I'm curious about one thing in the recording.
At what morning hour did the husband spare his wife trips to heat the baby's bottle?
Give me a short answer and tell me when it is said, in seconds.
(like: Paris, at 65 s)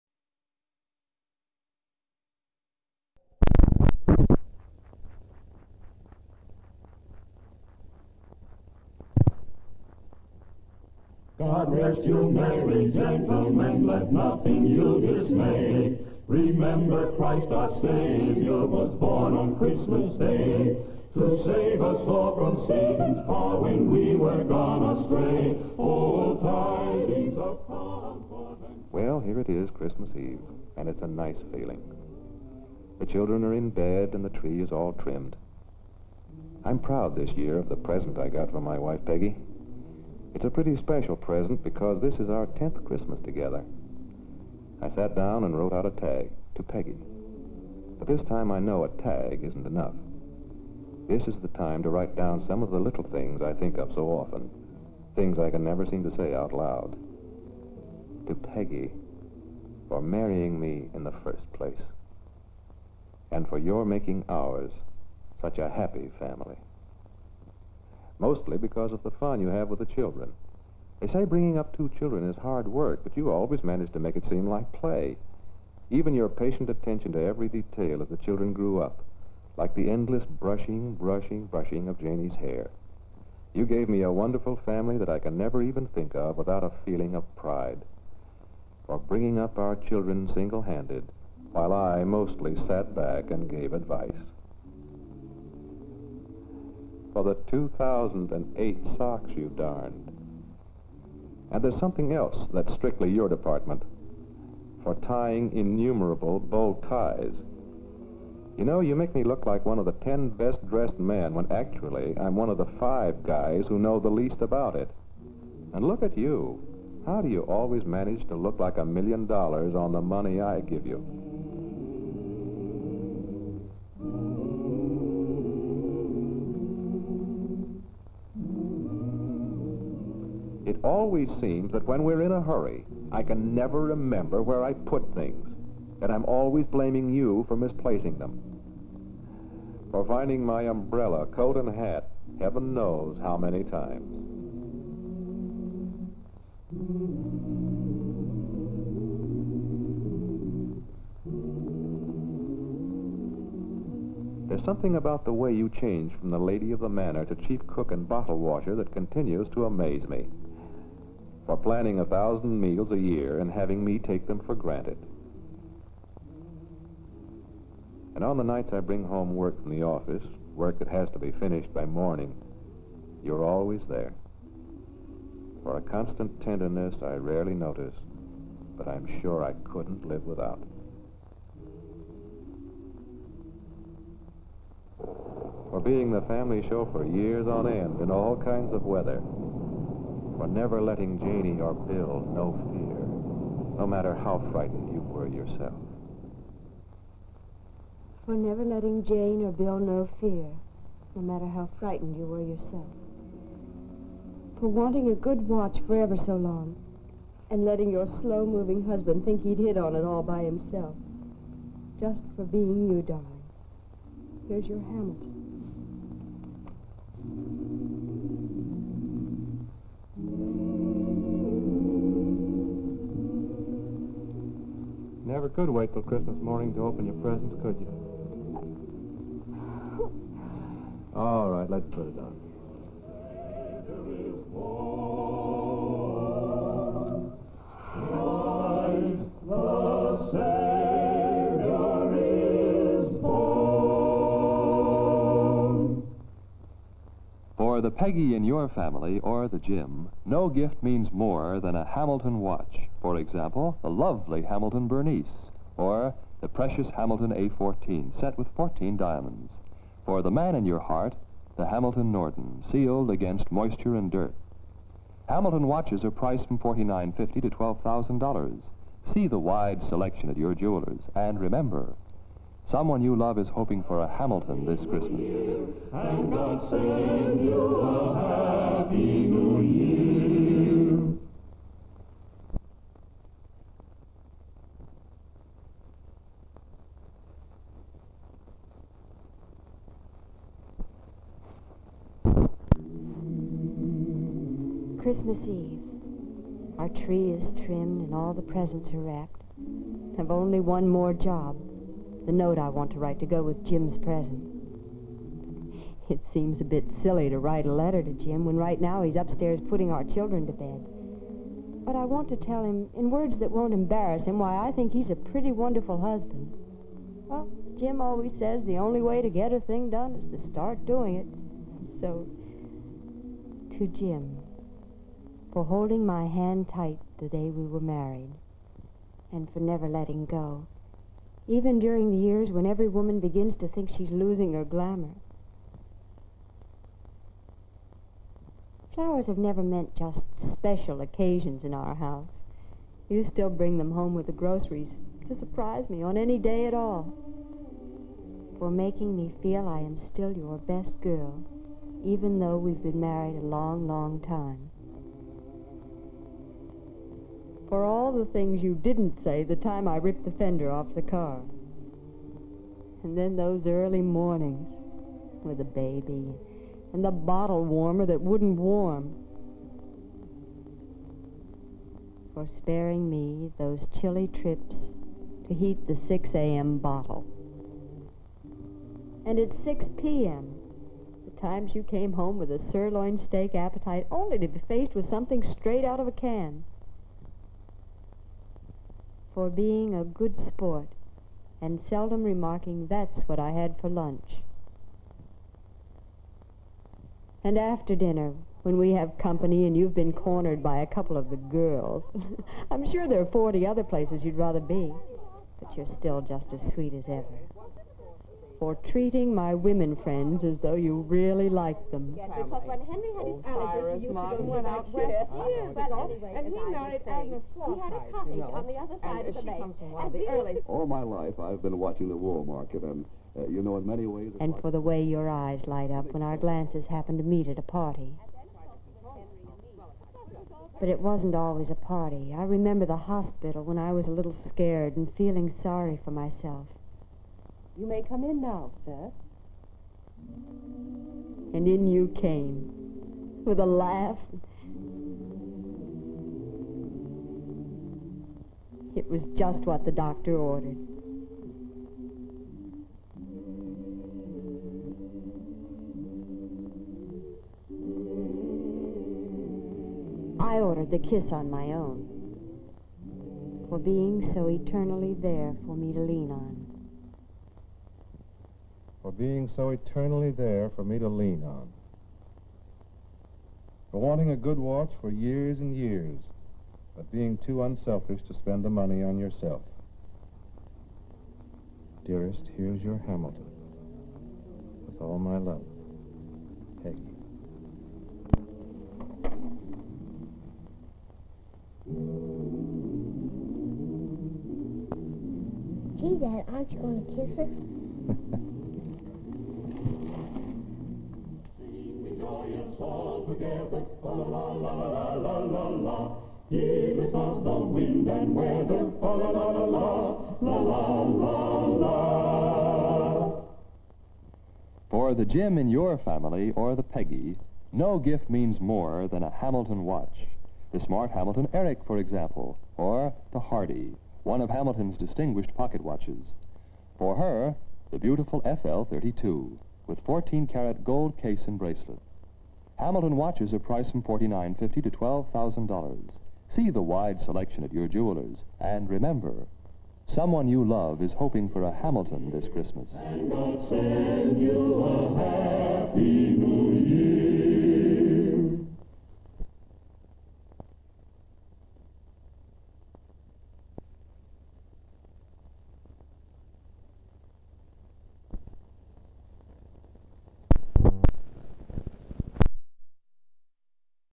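6 a.m., at 375 s.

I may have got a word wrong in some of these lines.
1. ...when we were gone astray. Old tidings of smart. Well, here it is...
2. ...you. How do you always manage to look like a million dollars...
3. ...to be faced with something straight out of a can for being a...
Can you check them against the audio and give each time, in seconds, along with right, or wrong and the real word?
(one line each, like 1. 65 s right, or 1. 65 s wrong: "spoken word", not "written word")
1. 23 s wrong: "comfort", not "smart"
2. 116 s right
3. 384 s right.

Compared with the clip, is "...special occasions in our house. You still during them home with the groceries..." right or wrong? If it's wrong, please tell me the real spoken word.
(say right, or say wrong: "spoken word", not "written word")
wrong: "bring", not "during".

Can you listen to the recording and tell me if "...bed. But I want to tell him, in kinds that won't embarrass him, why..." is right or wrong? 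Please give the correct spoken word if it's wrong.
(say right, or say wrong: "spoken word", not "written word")
wrong: "words", not "kinds".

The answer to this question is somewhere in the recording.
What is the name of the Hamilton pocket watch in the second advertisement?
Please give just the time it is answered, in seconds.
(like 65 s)
523 s.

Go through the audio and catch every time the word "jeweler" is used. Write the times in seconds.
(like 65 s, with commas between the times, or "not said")
270 s, 537 s.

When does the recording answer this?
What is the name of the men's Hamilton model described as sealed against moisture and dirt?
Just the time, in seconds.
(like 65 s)
261 s.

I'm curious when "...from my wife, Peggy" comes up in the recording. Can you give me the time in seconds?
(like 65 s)
38 s.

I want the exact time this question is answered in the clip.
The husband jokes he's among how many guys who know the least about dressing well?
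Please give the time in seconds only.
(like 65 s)
112 s.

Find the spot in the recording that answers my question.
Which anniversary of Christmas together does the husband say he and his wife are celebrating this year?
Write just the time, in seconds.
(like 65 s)
42 s.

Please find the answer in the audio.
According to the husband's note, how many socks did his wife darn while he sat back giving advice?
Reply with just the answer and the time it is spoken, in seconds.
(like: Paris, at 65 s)
2008, at 97 s.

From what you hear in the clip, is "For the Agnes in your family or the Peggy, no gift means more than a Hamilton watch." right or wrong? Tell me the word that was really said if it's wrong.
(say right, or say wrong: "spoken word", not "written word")
wrong: "Jim", not "Agnes".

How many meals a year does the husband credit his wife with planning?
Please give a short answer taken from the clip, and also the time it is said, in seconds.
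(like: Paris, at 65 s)
a thousand, at 161 s.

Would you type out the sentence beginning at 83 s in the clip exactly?
You gave me a wonderful family that I can never even think of without a feeling of pride.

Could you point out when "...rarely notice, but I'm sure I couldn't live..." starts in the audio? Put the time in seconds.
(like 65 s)
177 s.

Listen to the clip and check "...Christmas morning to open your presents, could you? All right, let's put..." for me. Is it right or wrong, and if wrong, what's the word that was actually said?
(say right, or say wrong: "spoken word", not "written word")
right.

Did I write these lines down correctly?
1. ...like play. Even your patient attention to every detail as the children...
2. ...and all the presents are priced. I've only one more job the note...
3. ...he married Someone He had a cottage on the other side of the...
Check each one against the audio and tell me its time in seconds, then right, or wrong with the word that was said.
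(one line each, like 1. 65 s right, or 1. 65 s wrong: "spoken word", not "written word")
1. 74 s right
2. 298 s wrong: "wrapped", not "priced"
3. 416 s wrong: "Agnes", not "Someone".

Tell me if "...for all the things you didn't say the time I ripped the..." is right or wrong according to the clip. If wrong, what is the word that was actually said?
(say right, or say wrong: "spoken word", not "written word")
right.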